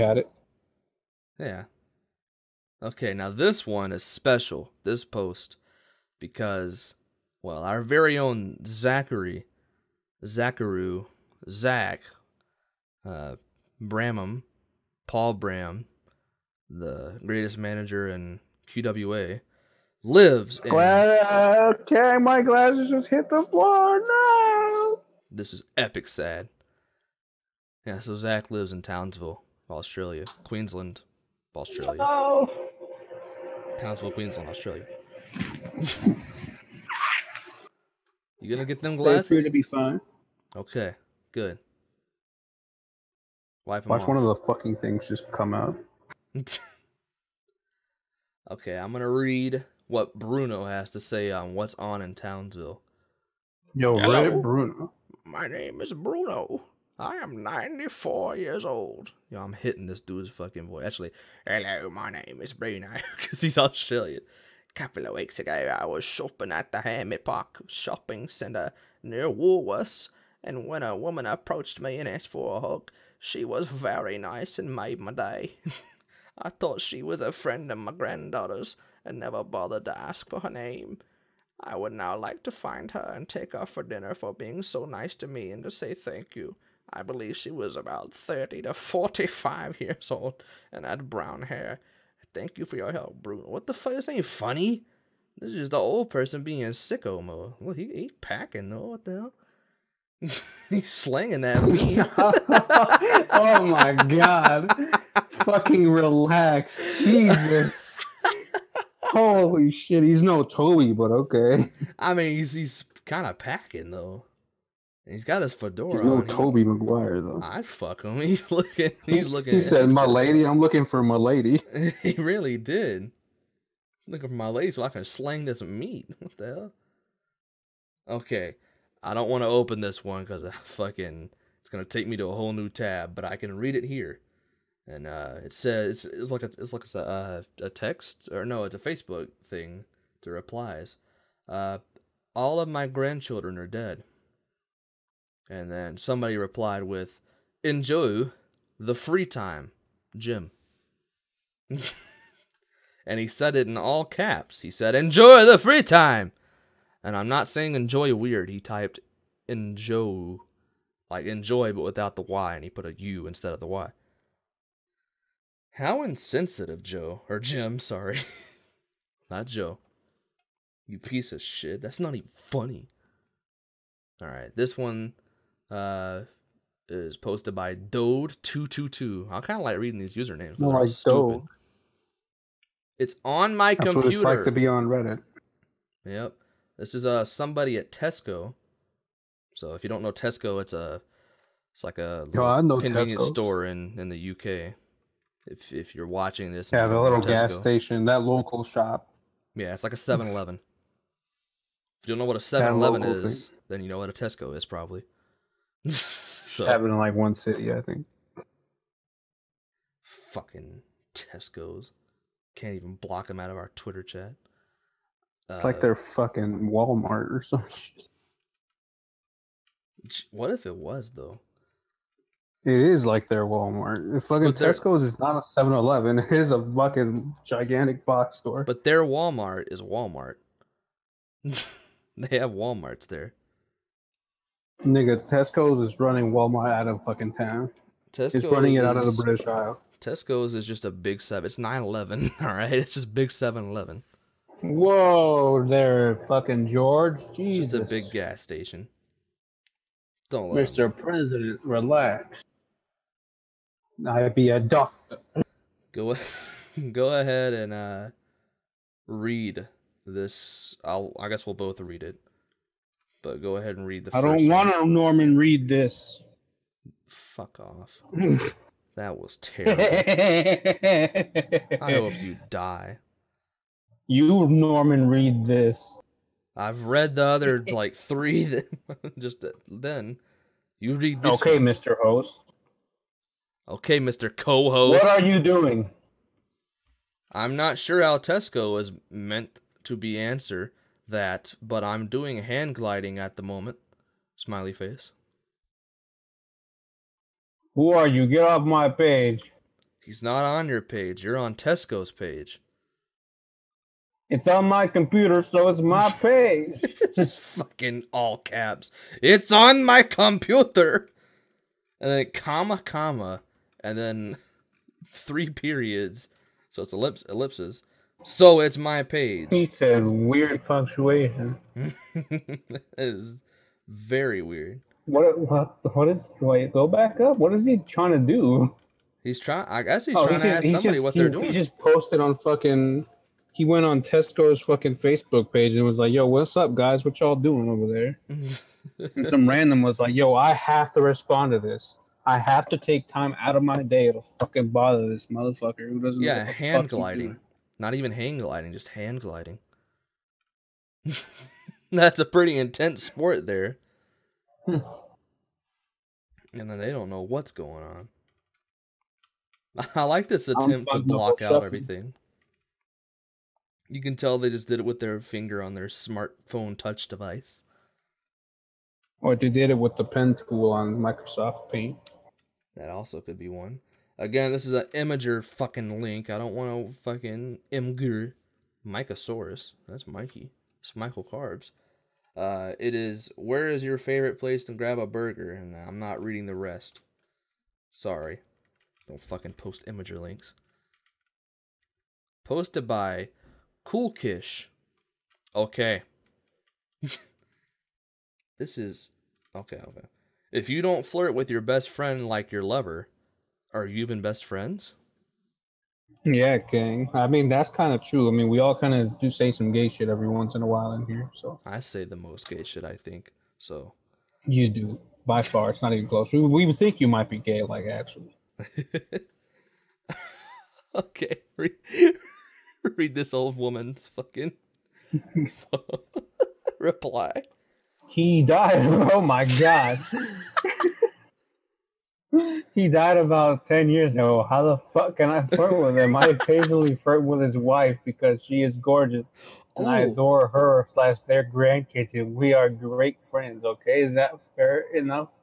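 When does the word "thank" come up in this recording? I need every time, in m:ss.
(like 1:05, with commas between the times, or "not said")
1:25, 1:32.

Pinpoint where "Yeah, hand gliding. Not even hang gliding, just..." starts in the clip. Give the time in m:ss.
5:46.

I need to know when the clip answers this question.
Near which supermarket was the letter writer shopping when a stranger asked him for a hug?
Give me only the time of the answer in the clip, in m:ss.
1:09.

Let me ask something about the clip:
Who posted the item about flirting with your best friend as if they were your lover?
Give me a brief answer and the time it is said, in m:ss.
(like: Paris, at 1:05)
Coolkish, at 6:33.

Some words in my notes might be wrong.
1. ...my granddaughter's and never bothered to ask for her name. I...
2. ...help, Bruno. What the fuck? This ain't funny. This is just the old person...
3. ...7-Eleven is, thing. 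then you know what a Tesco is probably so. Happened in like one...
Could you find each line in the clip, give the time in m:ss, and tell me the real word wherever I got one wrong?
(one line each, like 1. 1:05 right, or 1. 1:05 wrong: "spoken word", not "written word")
1. 1:17 right
2. 1:32 right
3. 3:22 right.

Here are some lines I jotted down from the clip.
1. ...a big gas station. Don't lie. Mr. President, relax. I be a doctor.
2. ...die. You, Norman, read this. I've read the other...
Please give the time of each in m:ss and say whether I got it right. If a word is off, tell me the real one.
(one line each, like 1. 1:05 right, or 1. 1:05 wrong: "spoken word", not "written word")
1. 4:07 right
2. 4:32 right.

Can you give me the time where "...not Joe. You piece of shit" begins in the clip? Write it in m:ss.
2:49.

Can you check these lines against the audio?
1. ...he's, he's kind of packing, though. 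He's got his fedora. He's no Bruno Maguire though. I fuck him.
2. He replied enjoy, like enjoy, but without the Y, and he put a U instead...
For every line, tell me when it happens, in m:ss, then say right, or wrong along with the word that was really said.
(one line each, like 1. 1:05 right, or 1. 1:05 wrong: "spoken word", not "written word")
1. 1:52 wrong: "Tobey", not "Bruno"
2. 2:38 wrong: "typed", not "replied".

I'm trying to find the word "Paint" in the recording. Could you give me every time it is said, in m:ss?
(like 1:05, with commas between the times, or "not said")
6:11.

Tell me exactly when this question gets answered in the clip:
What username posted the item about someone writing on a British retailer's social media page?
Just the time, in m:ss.
2:57.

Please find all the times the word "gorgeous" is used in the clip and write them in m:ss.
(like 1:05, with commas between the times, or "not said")
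7:18.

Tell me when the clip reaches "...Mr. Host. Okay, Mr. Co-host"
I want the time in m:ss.
4:41.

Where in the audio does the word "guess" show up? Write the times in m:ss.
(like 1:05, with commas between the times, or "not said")
4:21, 5:29.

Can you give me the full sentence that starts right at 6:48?
I mean, we all kind of do say some gay shit every once in a while in here.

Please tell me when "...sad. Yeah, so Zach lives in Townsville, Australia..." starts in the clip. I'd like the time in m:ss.
0:26.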